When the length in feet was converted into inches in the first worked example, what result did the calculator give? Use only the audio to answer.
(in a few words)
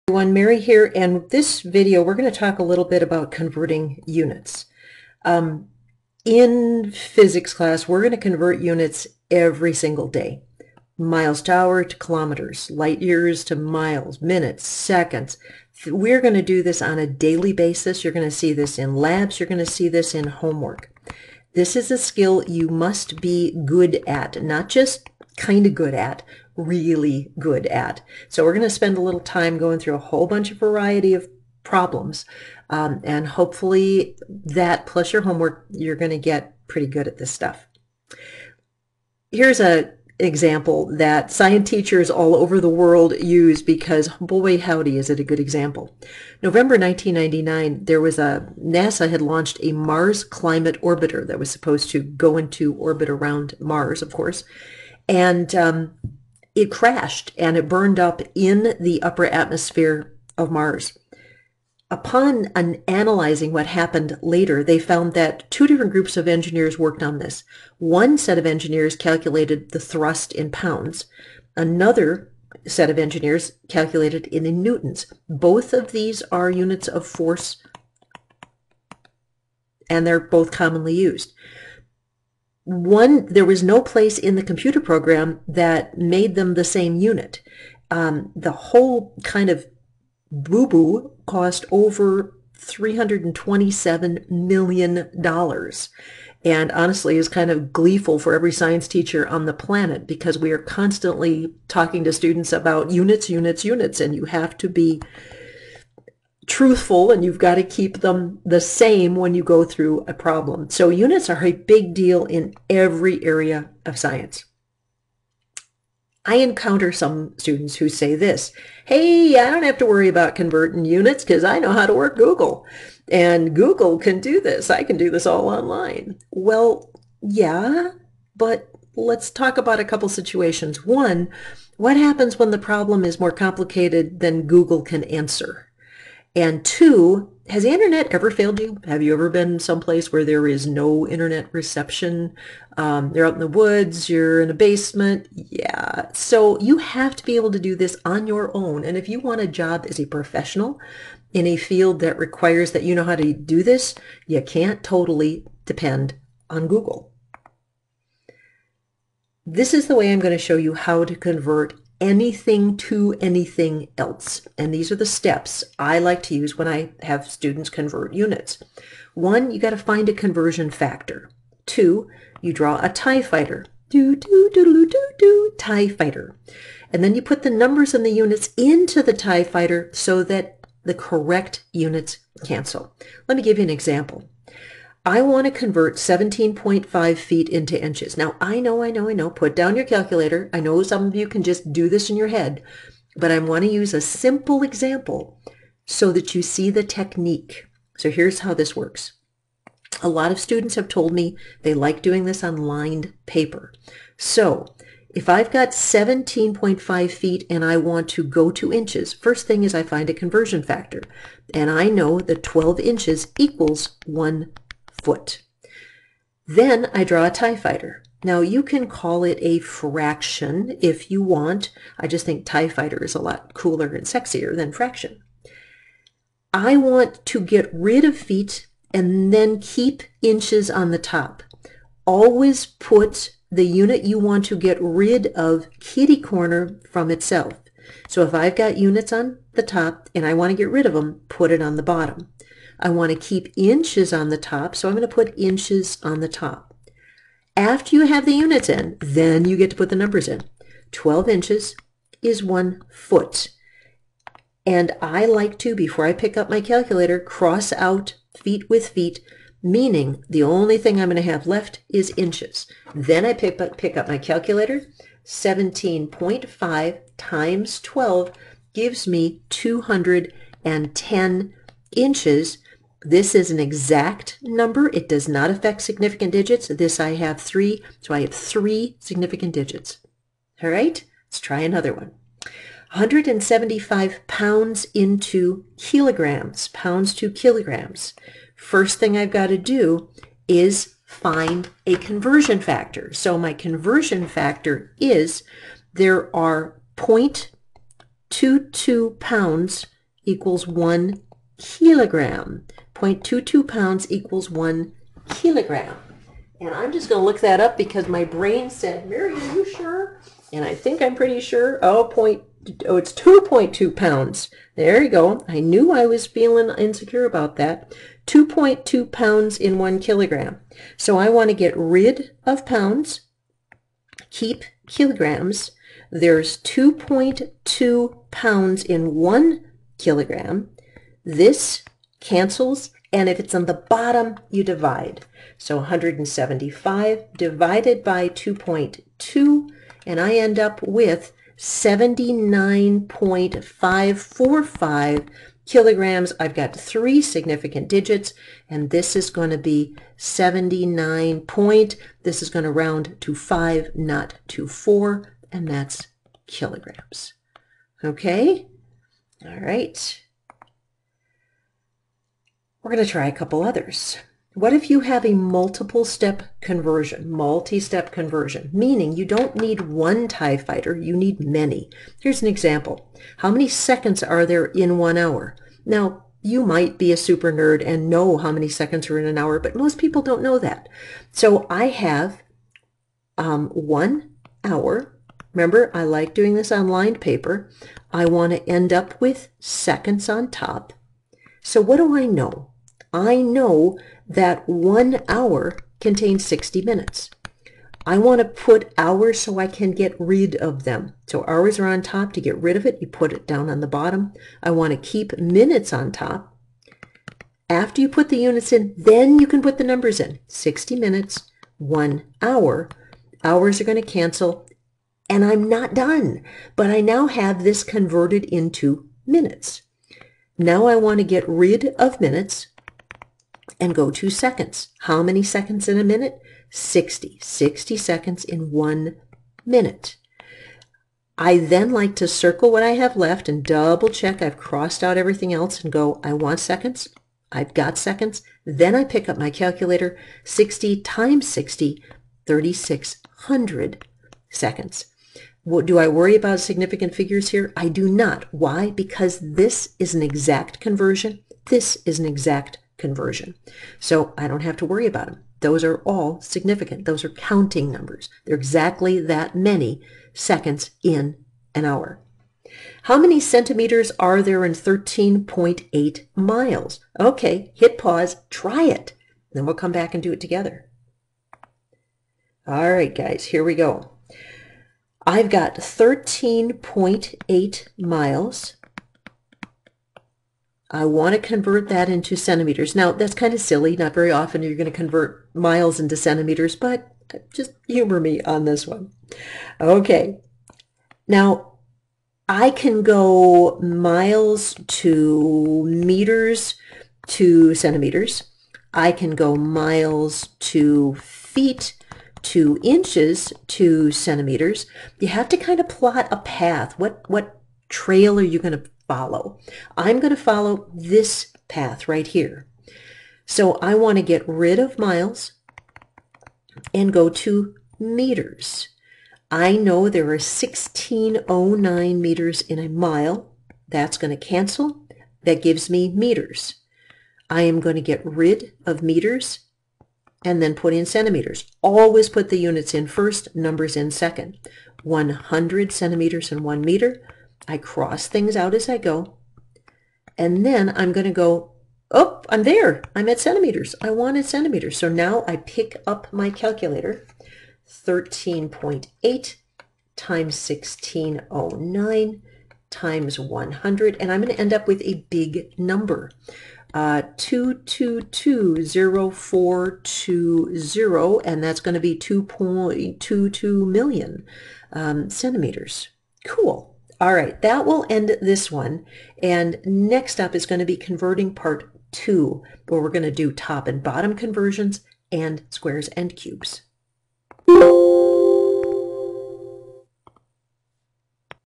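210 inches.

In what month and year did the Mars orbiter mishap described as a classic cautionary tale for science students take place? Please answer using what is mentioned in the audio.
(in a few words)
November 1999.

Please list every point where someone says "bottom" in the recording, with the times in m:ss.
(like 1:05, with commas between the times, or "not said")
4:01, 5:33, 6:43, 9:34.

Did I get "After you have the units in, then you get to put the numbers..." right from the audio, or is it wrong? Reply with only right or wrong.
right.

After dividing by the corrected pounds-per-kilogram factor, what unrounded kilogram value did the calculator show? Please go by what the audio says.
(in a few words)
79.545.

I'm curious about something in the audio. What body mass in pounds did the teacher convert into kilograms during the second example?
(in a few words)
175 pounds.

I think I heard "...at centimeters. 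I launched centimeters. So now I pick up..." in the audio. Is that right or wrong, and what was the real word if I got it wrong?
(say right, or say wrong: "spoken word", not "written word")
wrong: "wanted", not "launched".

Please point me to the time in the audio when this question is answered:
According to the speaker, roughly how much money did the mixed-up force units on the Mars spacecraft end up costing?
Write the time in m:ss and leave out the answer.
1:32.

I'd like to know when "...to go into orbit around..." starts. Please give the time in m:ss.
0:51.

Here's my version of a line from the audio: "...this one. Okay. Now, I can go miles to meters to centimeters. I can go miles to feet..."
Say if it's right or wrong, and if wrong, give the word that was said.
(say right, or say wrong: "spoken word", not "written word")
right.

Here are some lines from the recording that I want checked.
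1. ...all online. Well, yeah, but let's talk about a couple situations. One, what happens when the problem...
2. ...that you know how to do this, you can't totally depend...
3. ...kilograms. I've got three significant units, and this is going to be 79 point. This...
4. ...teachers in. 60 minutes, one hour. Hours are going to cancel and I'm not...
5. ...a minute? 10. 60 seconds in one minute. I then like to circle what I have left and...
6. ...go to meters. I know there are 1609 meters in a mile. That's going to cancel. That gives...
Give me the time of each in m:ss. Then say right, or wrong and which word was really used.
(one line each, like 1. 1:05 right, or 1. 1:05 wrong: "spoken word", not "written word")
1. 2:05 right
2. 2:32 right
3. 5:45 wrong: "digits", not "units"
4. 6:49 wrong: "numbers", not "teachers"
5. 7:05 wrong: "60", not "10"
6. 8:37 right.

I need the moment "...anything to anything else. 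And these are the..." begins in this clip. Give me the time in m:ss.
2:42.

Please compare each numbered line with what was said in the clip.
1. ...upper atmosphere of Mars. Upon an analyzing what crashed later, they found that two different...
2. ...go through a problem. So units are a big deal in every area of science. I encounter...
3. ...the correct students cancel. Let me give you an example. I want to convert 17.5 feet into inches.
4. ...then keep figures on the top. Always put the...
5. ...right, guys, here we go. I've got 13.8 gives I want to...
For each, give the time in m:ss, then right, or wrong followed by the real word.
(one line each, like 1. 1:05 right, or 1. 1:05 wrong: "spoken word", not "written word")
1. 0:59 wrong: "happened", not "crashed"
2. 1:49 right
3. 3:00 wrong: "units", not "students"
4. 3:49 wrong: "inches", not "figures"
5. 7:52 wrong: "miles", not "gives".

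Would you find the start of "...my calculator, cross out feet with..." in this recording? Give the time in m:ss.
4:16.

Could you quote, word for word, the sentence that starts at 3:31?
And I know that 12 inches equals one foot.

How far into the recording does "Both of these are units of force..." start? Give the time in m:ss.
1:15.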